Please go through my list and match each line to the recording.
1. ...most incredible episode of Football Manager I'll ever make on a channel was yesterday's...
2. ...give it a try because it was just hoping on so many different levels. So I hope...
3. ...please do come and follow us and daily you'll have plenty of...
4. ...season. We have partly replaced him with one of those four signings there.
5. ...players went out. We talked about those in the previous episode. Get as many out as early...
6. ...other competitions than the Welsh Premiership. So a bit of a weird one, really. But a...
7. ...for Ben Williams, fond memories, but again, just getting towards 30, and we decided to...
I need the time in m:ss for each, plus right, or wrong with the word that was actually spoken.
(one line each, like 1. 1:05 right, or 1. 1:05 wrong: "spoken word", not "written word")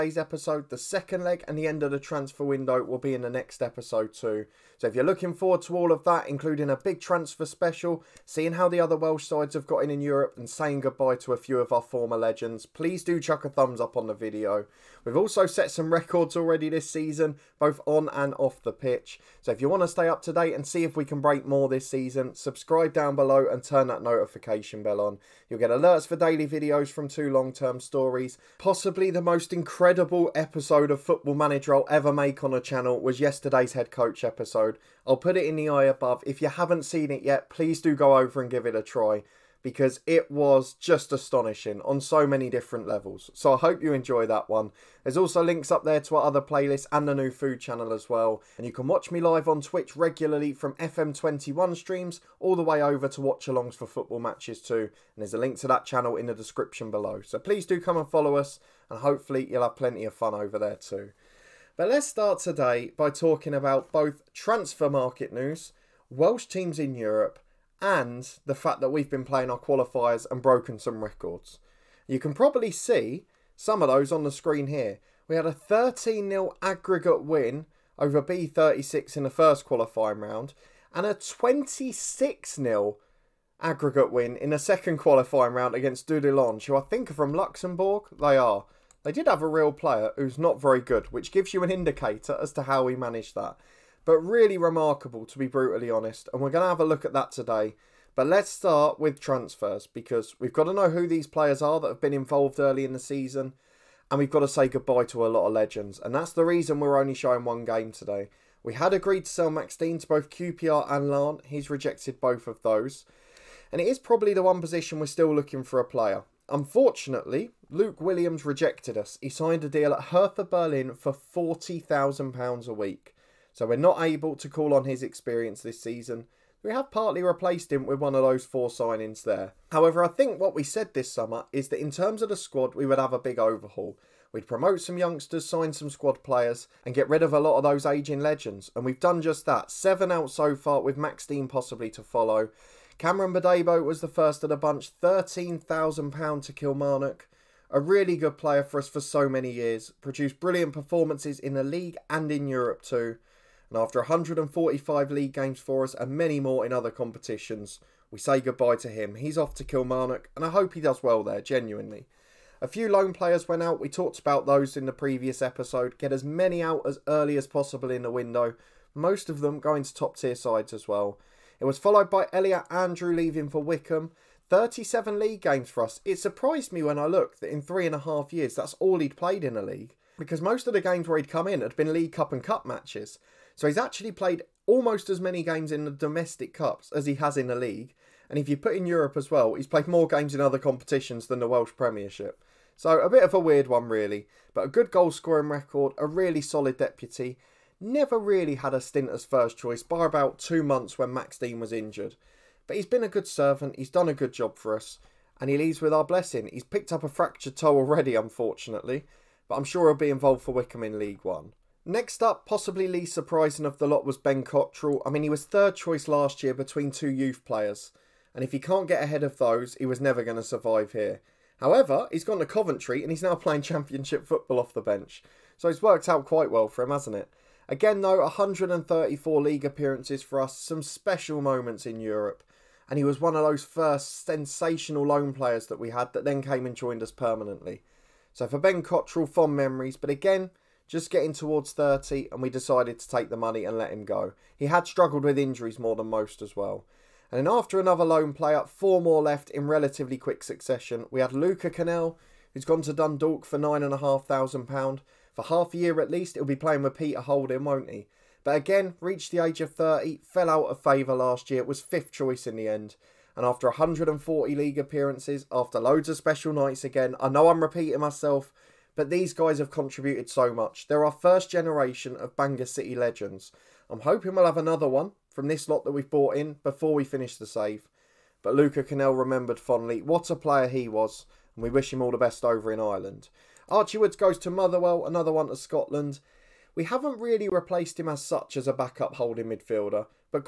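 1. 0:29 right
2. 0:38 wrong: "astonishing", not "hoping"
3. 0:57 wrong: "hopefully", not "daily"
4. 2:05 right
5. 2:43 right
6. 3:10 right
7. 3:58 wrong: "Cottrell", not "Williams".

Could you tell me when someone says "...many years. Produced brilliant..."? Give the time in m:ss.
2:29.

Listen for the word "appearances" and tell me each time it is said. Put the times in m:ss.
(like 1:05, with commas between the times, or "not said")
3:49, 4:24.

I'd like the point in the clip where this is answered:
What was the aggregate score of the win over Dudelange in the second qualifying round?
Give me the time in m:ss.
1:21.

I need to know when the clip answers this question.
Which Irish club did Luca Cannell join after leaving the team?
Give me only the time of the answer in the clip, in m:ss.
4:12.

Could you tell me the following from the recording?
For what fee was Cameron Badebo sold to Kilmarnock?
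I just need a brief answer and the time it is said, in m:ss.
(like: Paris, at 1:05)
£13,000, at 2:24.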